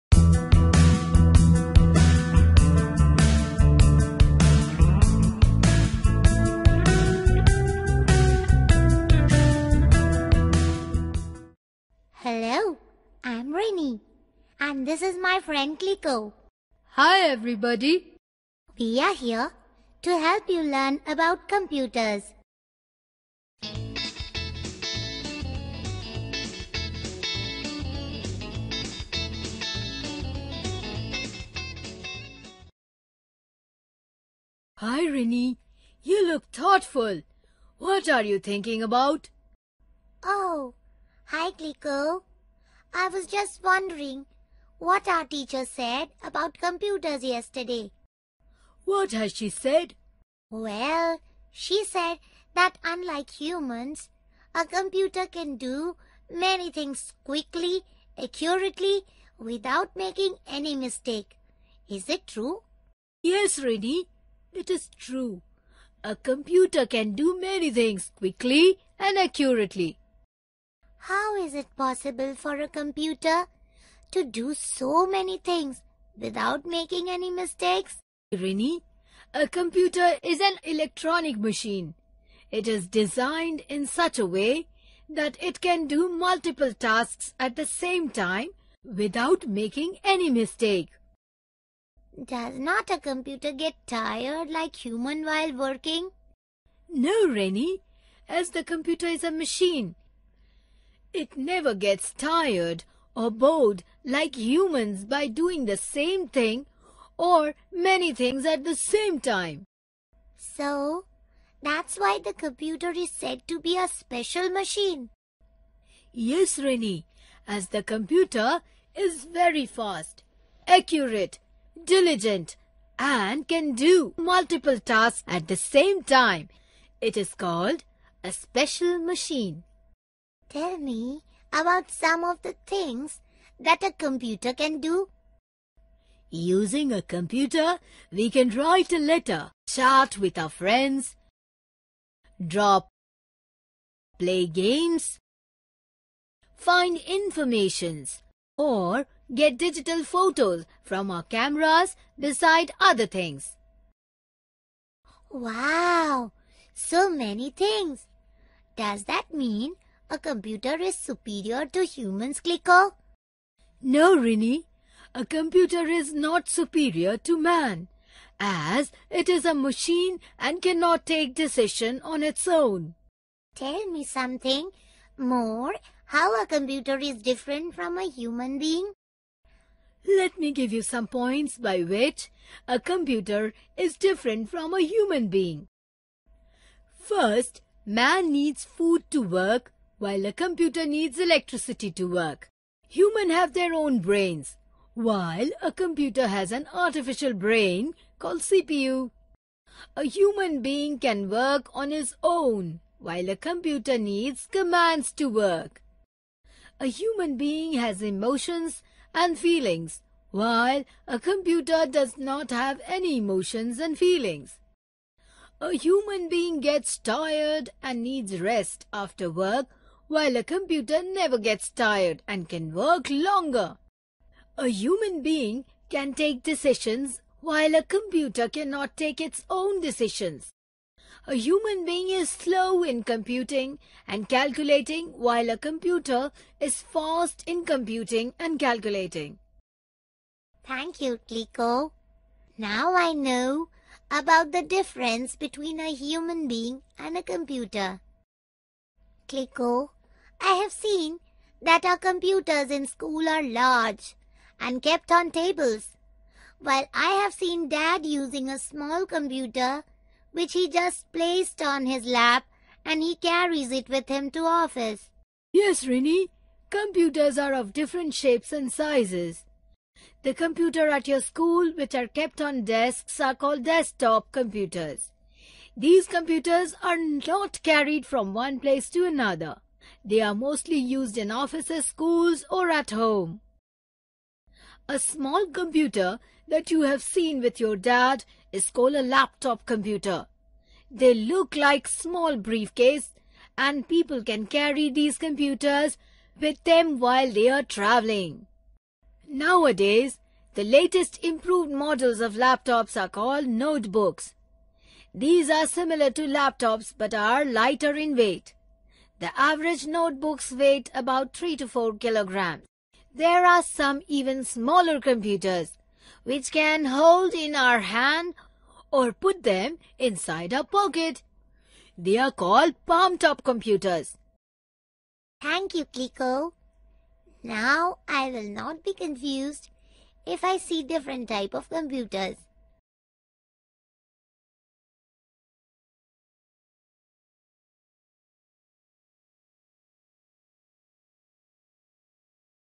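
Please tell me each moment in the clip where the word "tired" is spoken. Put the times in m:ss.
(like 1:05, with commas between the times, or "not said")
1:33, 1:42, 3:36, 3:41.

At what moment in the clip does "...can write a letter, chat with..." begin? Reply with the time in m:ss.
2:18.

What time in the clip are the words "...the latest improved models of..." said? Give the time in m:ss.
5:00.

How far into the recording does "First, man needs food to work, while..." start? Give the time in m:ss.
3:06.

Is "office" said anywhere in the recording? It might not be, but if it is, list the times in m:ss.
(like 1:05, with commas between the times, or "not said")
4:24, 4:41.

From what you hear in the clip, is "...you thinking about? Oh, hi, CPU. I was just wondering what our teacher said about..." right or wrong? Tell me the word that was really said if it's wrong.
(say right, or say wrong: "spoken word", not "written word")
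wrong: "Clico", not "CPU".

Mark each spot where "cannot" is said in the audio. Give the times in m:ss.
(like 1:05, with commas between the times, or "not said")
2:50, 3:48.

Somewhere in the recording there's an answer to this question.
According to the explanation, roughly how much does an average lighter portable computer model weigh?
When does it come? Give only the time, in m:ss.
5:11.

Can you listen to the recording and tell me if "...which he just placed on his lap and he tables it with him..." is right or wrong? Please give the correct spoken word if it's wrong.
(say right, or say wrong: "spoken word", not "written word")
wrong: "carries", not "tables".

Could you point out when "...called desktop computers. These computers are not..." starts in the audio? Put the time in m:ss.
4:33.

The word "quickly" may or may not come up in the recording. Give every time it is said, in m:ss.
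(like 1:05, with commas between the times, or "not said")
0:57, 1:08.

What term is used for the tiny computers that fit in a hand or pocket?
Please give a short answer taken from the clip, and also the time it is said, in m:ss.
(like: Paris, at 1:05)
Palm top computers, at 5:22.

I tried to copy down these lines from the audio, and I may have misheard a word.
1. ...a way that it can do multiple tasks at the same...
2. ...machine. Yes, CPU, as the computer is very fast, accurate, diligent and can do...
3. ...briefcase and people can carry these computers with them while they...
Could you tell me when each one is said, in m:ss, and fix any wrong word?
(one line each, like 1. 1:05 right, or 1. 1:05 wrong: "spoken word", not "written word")
1. 1:24 right
2. 1:54 wrong: "Rini", not "CPU"
3. 4:52 right.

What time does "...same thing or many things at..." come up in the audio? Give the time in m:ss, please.
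1:45.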